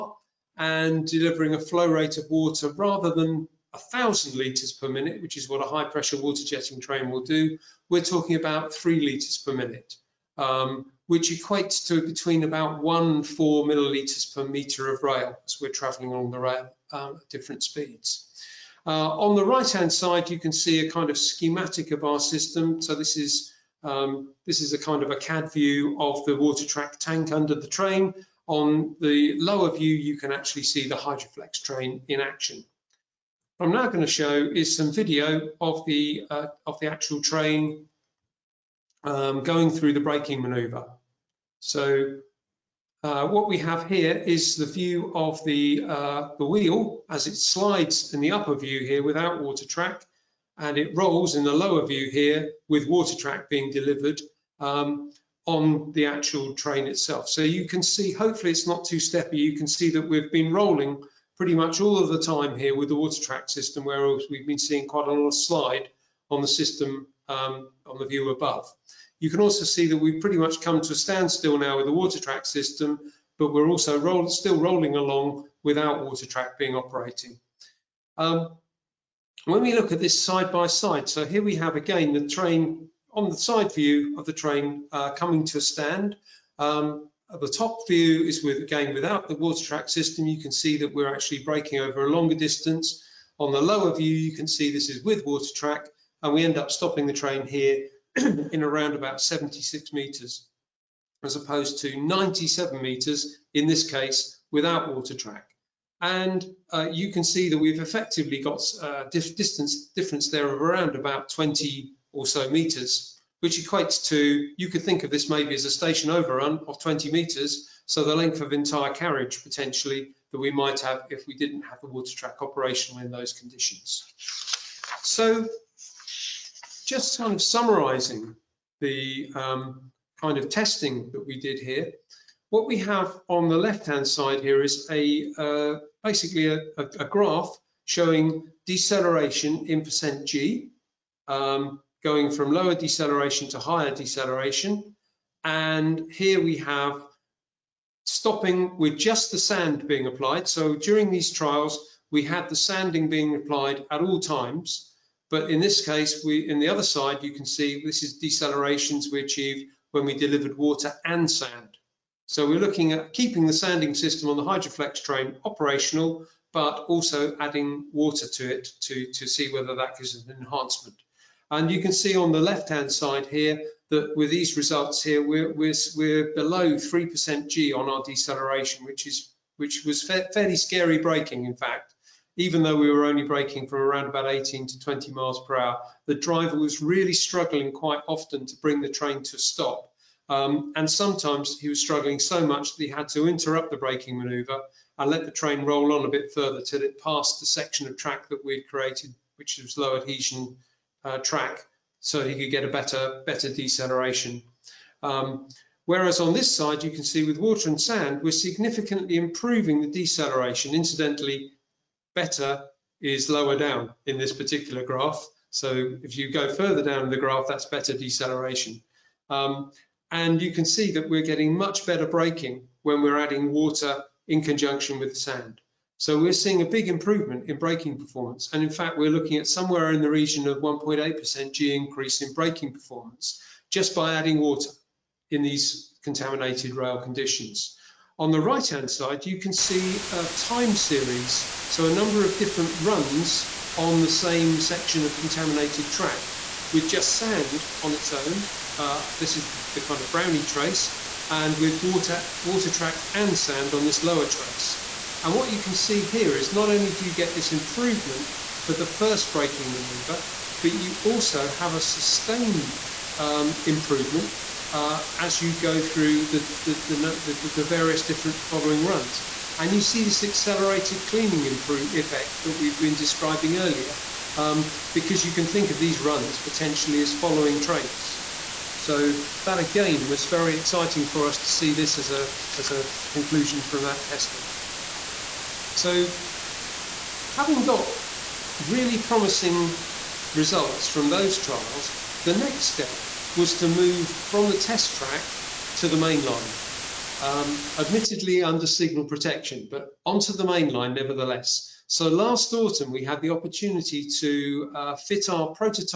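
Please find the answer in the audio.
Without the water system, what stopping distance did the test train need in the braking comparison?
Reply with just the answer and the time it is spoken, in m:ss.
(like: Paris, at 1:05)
97 meters, at 1:41.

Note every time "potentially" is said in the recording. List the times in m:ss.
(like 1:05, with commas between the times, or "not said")
1:59, 4:36.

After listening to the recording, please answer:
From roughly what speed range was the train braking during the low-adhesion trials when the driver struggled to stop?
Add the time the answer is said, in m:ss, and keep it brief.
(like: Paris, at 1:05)
18 to 20 mph, at 3:04.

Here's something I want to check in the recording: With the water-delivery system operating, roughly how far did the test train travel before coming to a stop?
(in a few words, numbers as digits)
76 meters.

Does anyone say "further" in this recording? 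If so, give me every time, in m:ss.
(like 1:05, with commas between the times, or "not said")
3:16, 3:36.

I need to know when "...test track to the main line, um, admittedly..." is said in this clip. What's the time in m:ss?
4:54.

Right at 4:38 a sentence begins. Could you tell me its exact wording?
So that again was very exciting for us to see this as a, as a conclusion from that testing.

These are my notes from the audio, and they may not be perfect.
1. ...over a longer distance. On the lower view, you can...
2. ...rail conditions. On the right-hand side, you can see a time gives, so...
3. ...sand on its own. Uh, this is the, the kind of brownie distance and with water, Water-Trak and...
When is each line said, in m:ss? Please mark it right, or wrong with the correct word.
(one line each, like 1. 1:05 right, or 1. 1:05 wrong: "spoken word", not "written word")
1. 1:31 right
2. 3:56 wrong: "series", not "gives"
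3. 4:07 wrong: "trace", not "distance".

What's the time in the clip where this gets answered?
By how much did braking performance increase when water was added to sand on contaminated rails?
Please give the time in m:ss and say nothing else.
3:50.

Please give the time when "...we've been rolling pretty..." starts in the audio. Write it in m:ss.
1:00.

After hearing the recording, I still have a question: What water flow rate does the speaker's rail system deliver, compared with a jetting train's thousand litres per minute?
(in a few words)
3 litres per minute.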